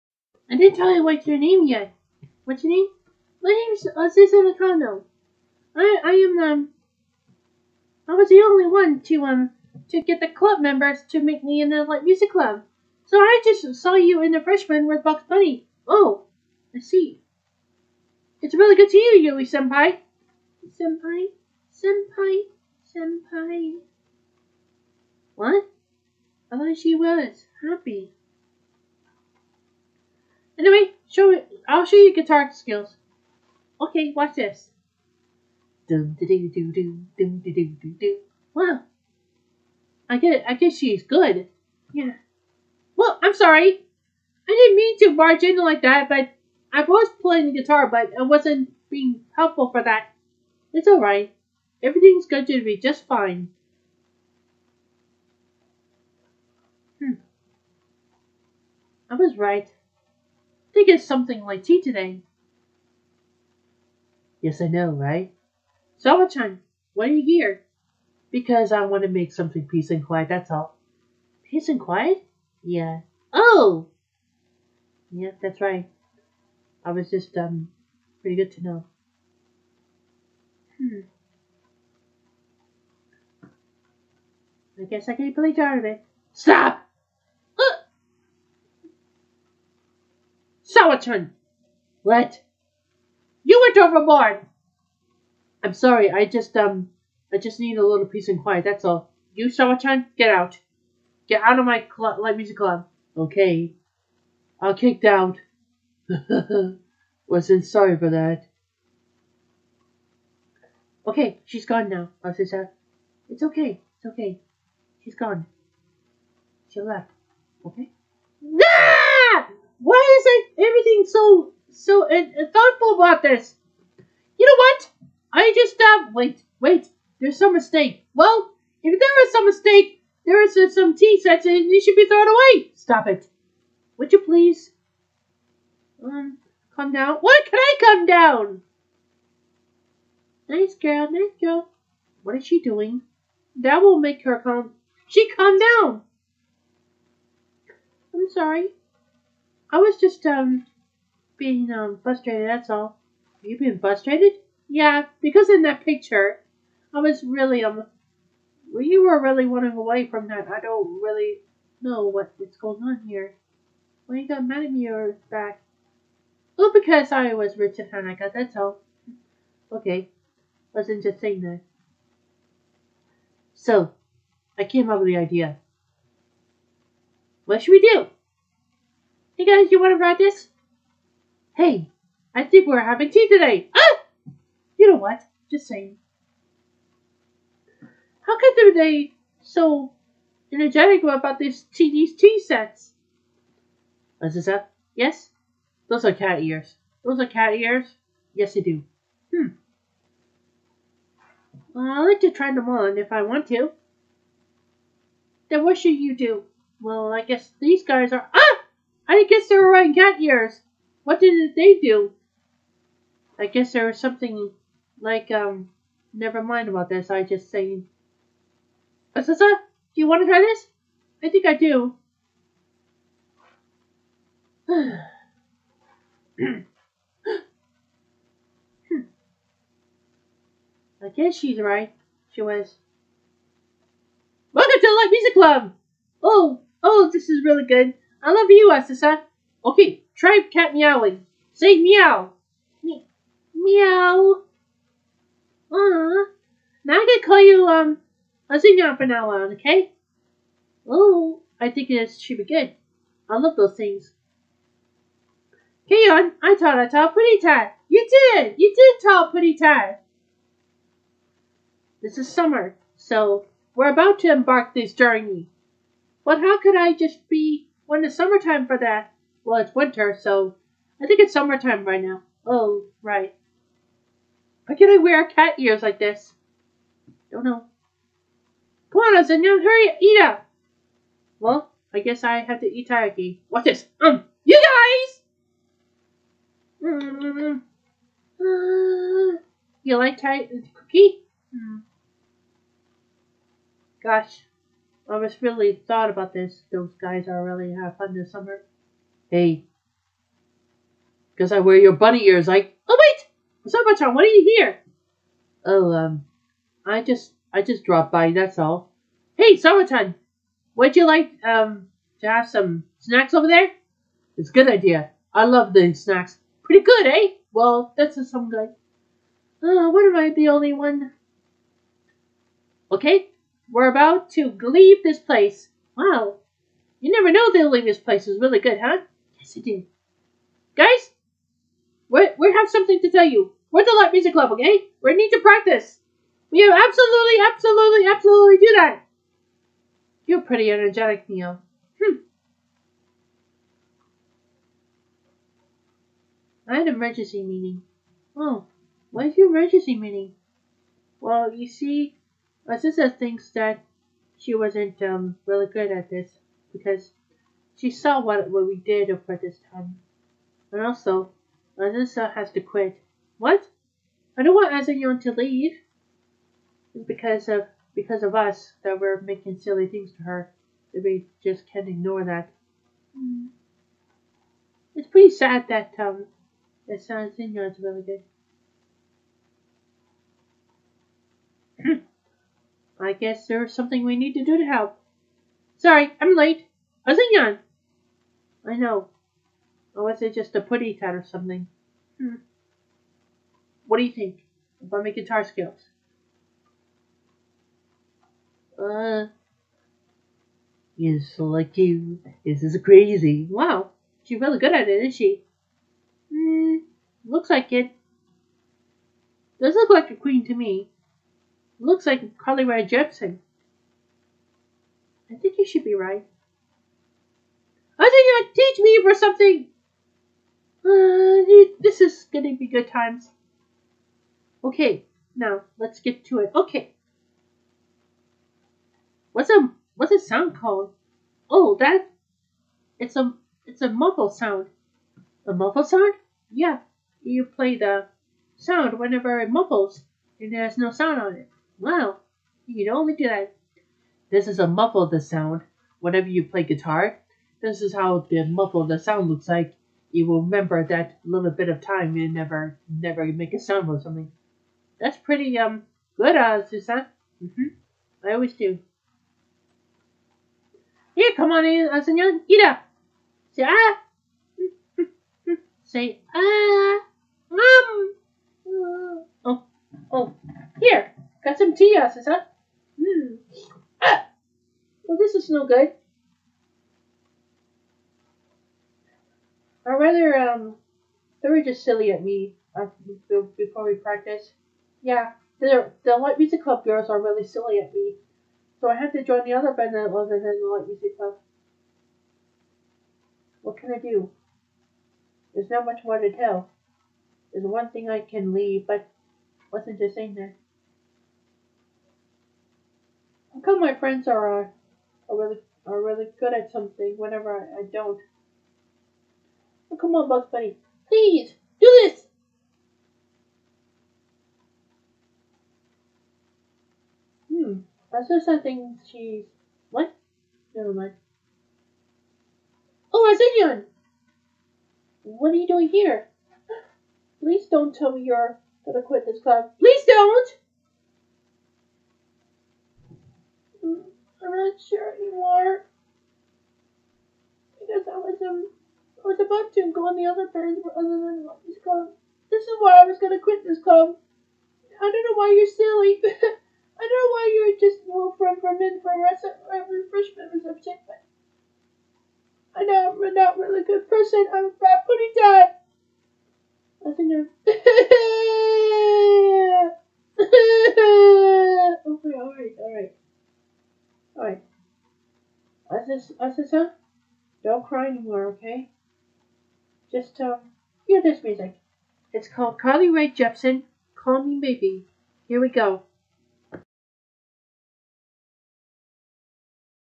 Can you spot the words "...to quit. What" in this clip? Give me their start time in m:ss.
6:02.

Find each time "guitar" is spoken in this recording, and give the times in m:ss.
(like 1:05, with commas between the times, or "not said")
0:32, 0:47, 6:35, 7:26.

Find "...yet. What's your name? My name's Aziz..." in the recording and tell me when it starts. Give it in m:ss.
0:01.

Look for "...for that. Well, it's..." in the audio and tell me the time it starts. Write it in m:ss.
4:28.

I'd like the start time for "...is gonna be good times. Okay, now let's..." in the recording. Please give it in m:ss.
7:01.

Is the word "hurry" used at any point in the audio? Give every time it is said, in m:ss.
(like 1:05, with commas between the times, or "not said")
4:39.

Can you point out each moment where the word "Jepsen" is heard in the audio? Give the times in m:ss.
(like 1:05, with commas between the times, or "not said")
6:52, 9:33.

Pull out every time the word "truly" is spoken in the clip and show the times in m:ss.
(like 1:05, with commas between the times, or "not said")
not said.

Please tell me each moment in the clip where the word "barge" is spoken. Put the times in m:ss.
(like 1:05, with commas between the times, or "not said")
0:45.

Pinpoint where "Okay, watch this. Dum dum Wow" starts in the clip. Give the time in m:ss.
0:33.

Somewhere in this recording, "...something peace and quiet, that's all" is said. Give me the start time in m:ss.
1:09.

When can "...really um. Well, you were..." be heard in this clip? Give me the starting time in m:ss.
2:37.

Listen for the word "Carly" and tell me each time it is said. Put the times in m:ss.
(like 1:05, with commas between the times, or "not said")
6:52, 9:32.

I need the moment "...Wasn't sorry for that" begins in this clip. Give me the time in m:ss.
1:47.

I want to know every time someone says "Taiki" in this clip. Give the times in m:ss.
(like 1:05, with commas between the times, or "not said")
4:42, 4:50.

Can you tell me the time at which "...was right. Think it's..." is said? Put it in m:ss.
0:59.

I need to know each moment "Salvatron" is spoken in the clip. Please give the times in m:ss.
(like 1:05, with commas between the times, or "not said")
1:06.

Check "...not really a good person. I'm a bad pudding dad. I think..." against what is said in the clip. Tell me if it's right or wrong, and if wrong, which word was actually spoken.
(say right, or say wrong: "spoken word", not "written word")
right.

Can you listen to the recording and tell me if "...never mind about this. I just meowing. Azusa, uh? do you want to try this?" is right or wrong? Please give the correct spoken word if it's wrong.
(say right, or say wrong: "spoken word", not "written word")
wrong: "saying", not "meowing".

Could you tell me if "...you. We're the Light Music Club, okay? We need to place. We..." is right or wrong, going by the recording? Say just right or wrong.
wrong.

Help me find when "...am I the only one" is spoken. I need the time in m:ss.
5:20.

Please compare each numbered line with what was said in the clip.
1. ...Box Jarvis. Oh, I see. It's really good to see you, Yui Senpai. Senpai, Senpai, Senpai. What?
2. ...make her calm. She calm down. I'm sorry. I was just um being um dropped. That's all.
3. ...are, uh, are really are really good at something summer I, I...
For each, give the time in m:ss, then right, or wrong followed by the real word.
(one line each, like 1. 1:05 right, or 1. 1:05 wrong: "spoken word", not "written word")
1. 0:15 wrong: "Bunny", not "Jarvis"
2. 2:23 wrong: "frustrated", not "dropped"
3. 8:24 wrong: "whenever", not "summer".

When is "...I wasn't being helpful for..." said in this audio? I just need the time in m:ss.
0:48.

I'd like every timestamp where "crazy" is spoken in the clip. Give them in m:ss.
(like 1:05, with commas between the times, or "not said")
6:42.